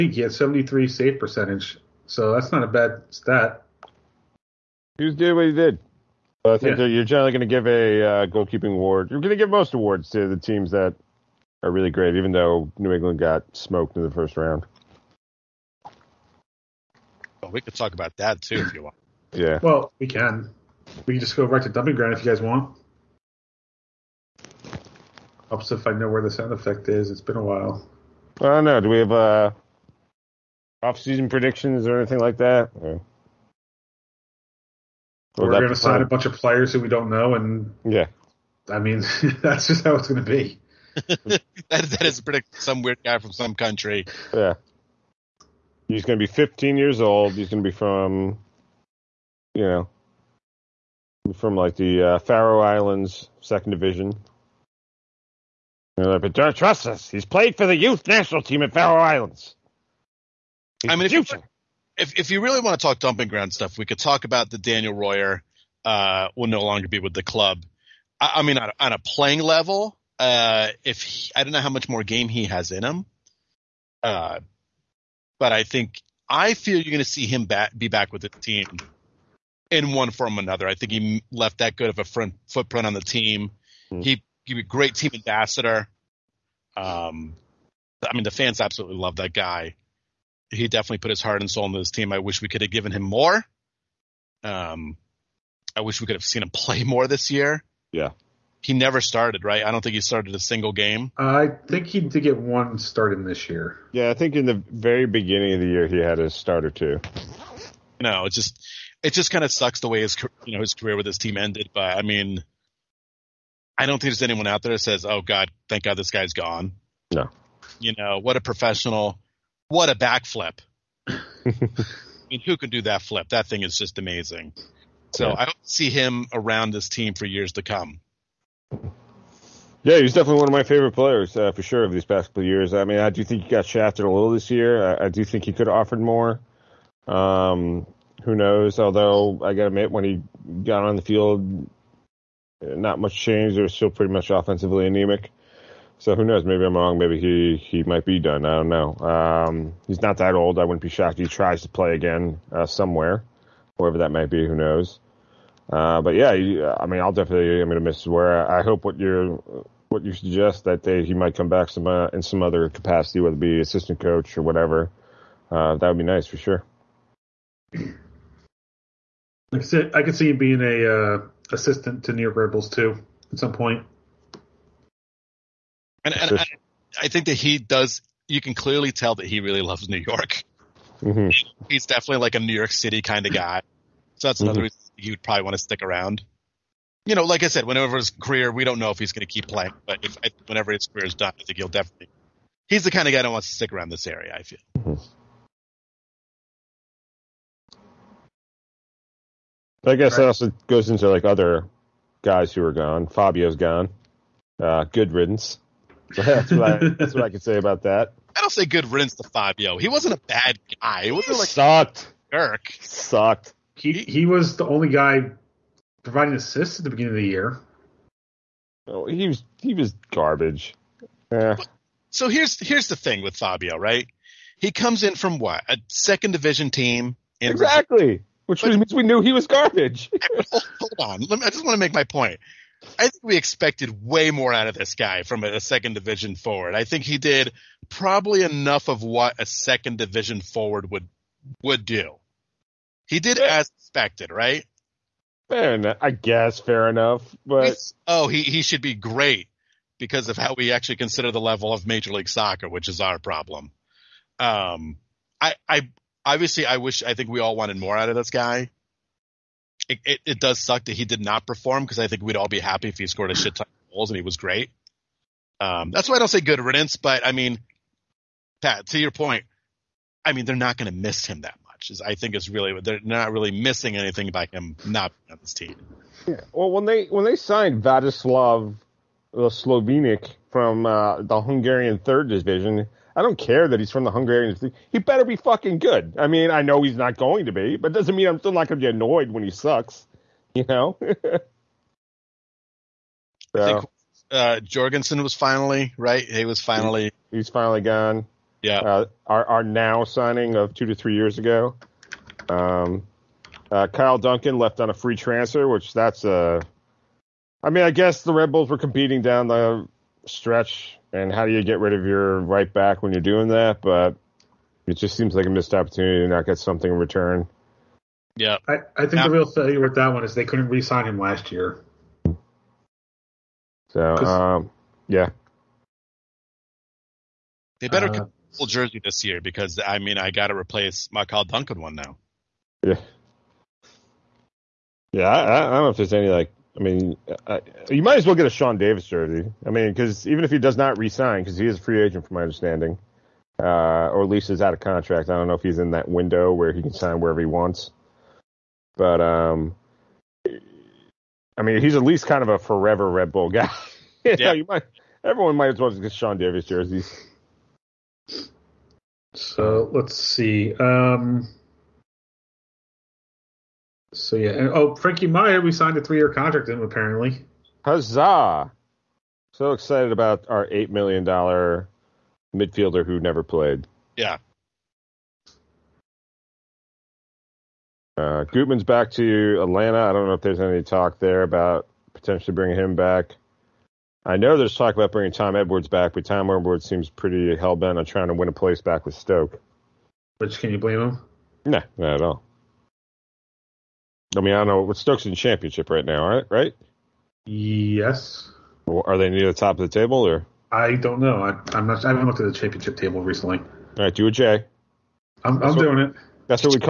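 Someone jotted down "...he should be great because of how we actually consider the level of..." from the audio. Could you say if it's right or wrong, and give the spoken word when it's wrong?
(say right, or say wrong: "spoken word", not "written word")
right.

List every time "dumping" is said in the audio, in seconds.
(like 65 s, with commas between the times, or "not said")
21 s, 62 s.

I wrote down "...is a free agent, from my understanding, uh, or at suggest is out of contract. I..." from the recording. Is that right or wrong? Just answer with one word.
wrong.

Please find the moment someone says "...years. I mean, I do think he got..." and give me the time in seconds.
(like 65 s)
132 s.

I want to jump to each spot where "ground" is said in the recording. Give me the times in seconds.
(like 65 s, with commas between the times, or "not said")
21 s, 63 s.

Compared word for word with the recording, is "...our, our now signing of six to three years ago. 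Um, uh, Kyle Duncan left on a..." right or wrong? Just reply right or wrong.
wrong.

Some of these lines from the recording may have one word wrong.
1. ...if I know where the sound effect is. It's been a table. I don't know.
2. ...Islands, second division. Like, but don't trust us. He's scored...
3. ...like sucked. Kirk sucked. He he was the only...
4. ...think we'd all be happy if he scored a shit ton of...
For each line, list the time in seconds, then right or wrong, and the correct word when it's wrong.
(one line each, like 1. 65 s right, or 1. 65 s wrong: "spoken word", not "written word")
1. 25 s wrong: "while", not "table"
2. 52 s wrong: "played", not "scored"
3. 211 s right
4. 262 s right.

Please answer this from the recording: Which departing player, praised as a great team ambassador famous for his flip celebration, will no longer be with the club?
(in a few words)
Daniel Royer.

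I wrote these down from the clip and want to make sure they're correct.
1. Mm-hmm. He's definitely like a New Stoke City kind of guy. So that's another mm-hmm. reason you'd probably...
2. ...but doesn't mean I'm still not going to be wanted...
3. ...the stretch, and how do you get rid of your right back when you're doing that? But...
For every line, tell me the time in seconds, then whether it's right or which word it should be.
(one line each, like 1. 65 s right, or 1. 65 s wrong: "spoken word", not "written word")
1. 181 s wrong: "York", not "Stoke"
2. 287 s wrong: "annoyed", not "wanted"
3. 309 s right.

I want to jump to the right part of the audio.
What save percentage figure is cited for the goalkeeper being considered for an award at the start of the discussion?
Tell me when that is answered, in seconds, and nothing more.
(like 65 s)
0 s.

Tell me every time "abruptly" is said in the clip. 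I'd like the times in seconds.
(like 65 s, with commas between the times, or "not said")
not said.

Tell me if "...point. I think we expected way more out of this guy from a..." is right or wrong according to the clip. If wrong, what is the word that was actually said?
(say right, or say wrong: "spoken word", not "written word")
right.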